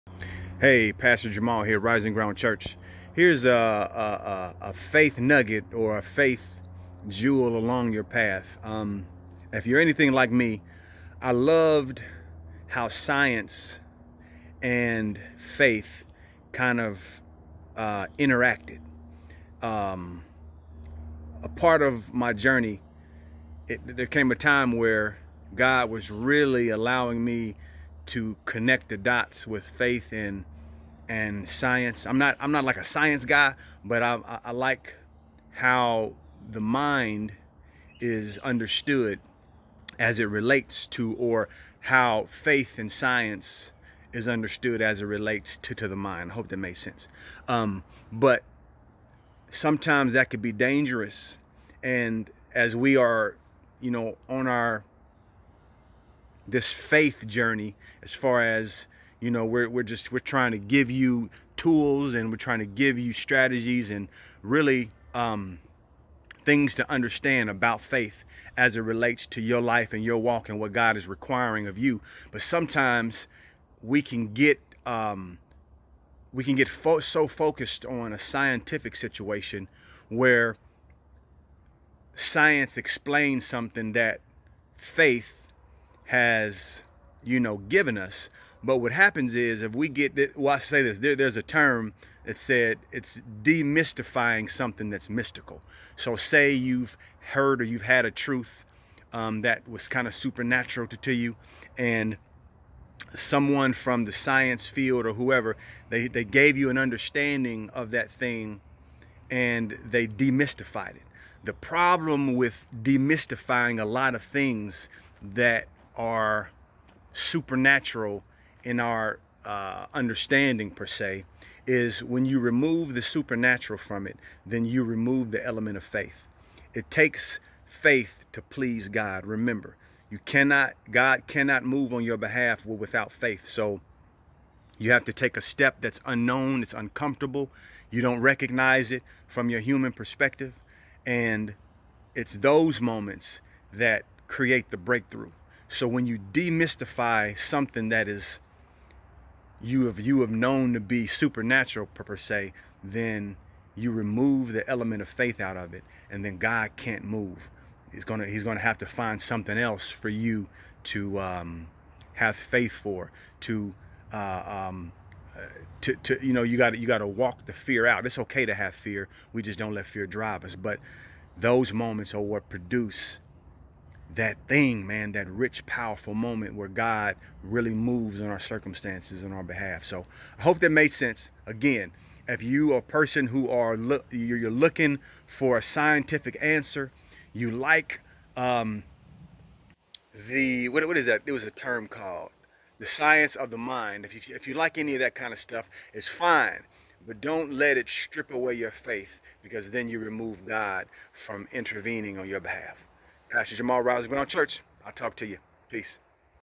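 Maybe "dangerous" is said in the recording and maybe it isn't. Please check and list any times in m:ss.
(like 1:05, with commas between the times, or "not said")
0:50.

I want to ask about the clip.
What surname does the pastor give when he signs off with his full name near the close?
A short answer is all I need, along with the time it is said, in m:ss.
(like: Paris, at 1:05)
Rousey, at 3:23.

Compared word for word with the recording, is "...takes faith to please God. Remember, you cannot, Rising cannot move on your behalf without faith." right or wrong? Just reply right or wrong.
wrong.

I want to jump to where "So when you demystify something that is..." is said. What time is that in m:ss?
2:25.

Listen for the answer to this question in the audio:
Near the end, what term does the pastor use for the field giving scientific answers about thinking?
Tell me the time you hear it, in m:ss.
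3:12.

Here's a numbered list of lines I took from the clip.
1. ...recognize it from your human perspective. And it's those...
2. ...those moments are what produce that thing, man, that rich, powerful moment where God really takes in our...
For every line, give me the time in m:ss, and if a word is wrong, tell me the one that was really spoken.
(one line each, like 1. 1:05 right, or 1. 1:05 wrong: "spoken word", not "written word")
1. 2:18 right
2. 2:51 wrong: "moves", not "takes".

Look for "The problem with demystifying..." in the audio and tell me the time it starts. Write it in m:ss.
1:51.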